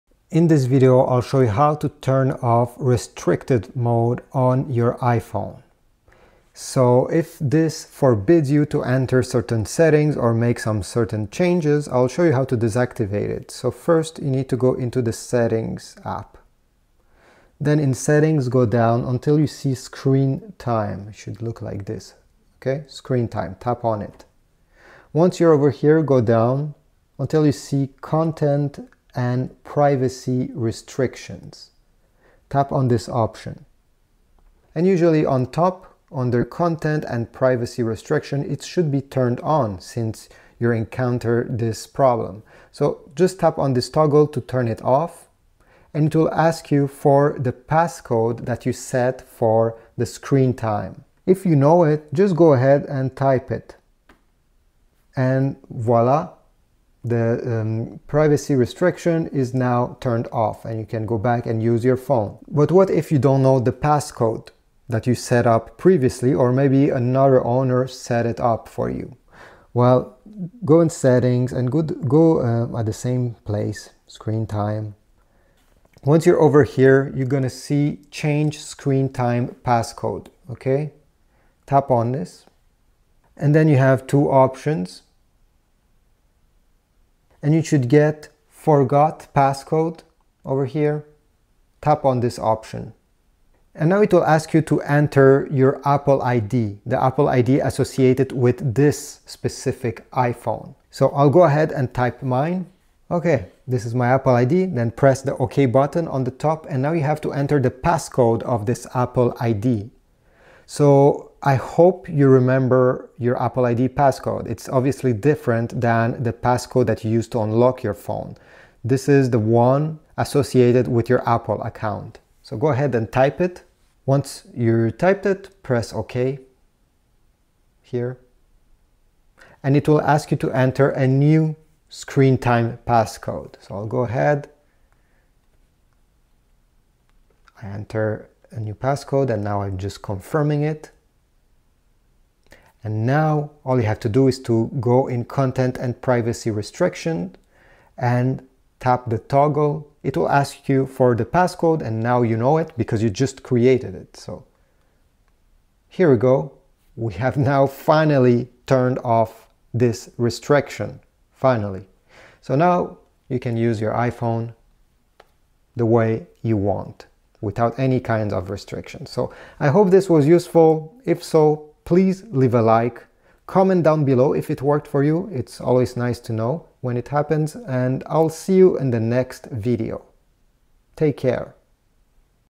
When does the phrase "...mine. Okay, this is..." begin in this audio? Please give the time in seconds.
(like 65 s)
102 s.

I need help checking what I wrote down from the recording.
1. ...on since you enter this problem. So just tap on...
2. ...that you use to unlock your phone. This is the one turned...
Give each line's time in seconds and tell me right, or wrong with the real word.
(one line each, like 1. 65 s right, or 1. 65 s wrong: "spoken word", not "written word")
1. 39 s wrong: "encounter", not "enter"
2. 116 s wrong: "associated", not "turned".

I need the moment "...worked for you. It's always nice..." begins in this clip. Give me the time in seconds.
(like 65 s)
174 s.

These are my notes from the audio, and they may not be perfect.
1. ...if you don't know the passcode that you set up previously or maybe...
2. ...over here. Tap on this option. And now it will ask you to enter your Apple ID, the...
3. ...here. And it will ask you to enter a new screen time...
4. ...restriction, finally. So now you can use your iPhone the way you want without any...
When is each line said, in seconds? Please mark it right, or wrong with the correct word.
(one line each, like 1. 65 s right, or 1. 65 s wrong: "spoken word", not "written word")
1. 62 s right
2. 90 s right
3. 127 s right
4. 160 s right.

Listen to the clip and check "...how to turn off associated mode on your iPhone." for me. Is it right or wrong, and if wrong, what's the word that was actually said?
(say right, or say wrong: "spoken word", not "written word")
wrong: "restricted", not "associated".